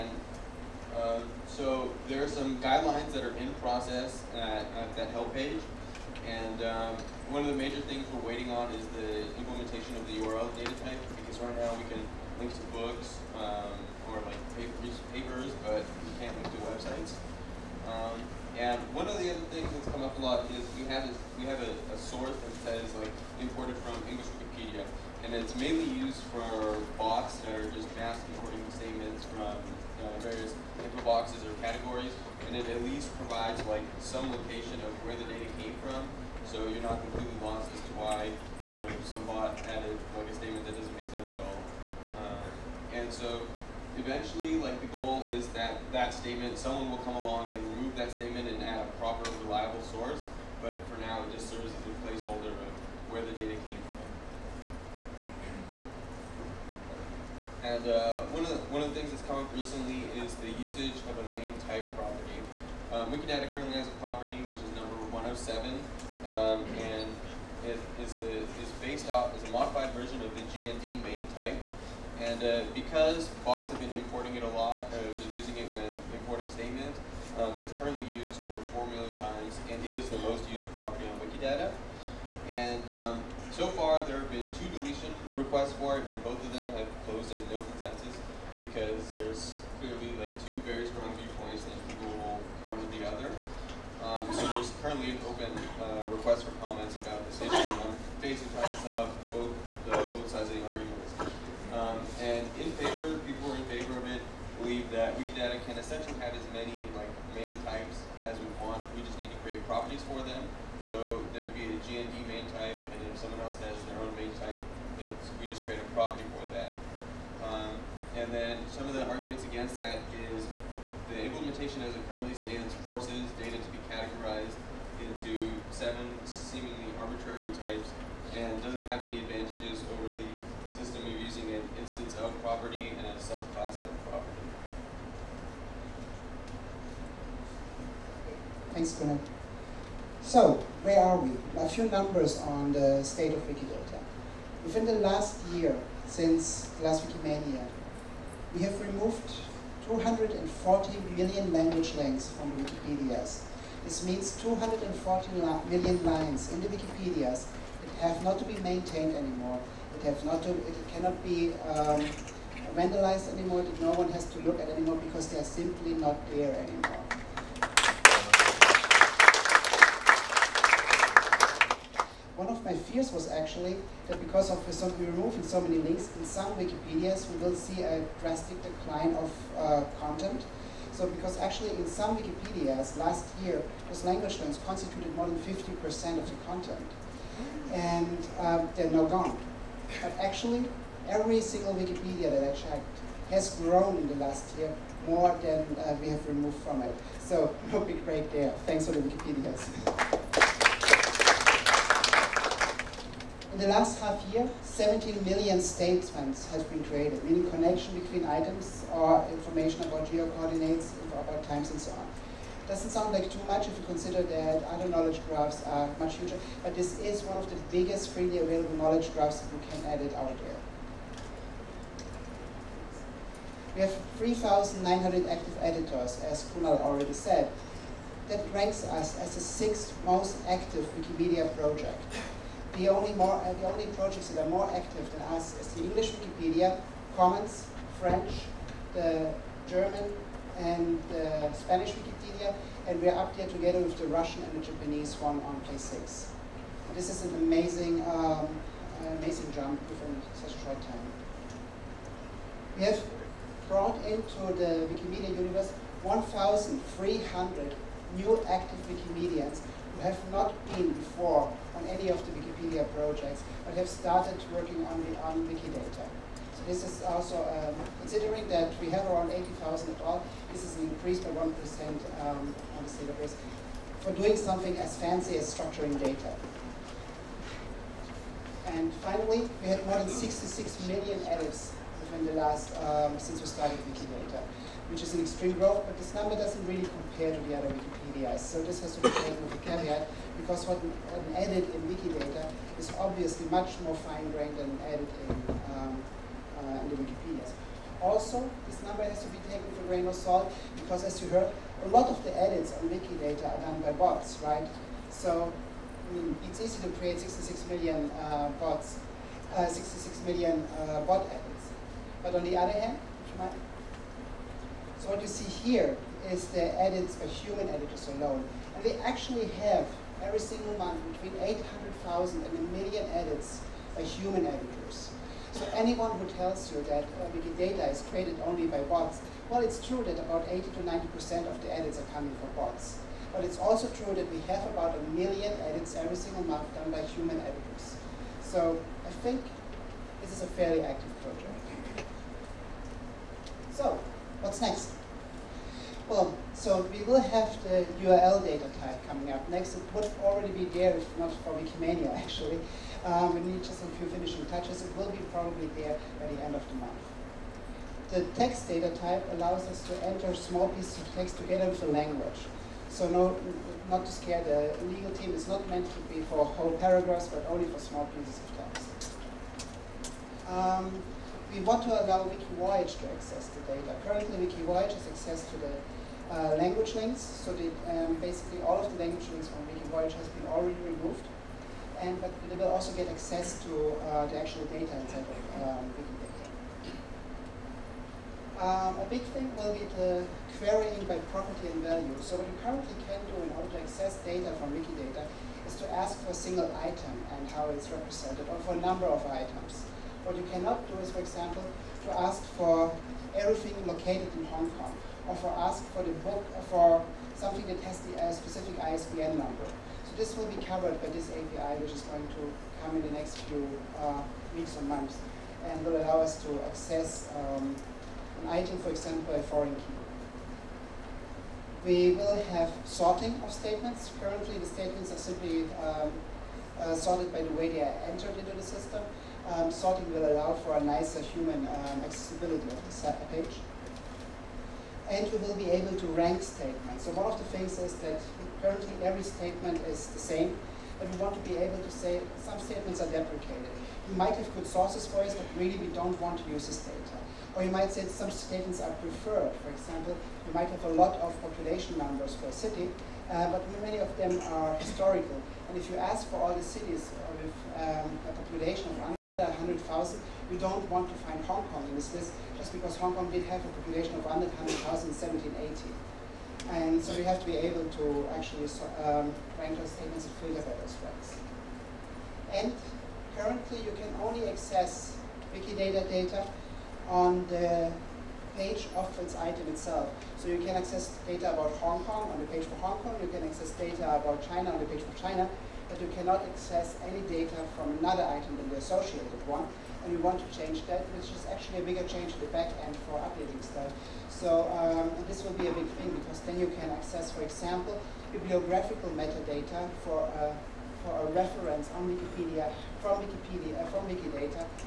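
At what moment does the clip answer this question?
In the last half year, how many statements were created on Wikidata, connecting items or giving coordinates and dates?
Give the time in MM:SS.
03:24.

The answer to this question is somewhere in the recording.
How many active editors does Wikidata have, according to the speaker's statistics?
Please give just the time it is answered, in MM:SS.
03:44.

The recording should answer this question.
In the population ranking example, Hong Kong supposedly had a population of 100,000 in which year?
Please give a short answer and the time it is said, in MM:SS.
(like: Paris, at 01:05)
1780, at 07:45.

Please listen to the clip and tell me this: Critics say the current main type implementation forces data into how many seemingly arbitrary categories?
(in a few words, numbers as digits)
7.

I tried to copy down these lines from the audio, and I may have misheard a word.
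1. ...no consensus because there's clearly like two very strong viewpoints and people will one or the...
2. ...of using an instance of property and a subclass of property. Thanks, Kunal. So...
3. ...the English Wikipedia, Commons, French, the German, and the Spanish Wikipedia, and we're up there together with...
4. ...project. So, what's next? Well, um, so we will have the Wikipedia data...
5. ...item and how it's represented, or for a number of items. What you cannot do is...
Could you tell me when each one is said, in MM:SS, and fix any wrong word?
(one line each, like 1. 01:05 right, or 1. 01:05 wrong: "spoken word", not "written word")
1. 01:27 right
2. 02:11 right
3. 03:55 right
4. 05:41 wrong: "URL", not "Wikipedia"
5. 06:36 right.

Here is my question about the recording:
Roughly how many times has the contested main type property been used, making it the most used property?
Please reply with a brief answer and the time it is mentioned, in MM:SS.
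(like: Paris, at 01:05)
4 million, at 01:18.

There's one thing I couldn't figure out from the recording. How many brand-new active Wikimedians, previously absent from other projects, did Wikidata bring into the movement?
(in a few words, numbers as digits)
1,300.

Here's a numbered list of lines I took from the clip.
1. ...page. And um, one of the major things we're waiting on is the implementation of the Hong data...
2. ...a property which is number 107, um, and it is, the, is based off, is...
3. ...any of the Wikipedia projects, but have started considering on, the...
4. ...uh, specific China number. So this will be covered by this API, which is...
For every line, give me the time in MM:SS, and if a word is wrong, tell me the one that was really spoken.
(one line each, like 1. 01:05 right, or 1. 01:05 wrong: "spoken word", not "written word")
1. 00:05 wrong: "URL", not "Hong"
2. 01:03 right
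3. 04:21 wrong: "working", not "considering"
4. 06:48 wrong: "ISBN", not "China".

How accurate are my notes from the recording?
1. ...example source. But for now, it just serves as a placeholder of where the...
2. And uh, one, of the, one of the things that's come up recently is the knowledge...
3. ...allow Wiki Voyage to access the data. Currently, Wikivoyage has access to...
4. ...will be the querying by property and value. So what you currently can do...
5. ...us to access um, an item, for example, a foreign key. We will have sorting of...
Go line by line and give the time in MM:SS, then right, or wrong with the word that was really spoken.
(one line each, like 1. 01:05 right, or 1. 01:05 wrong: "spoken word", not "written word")
1. 00:49 wrong: "reliable", not "example"
2. 00:57 wrong: "usage", not "knowledge"
3. 06:12 right
4. 06:29 right
5. 06:56 right.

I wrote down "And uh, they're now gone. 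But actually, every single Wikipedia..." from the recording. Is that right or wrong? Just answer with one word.
right.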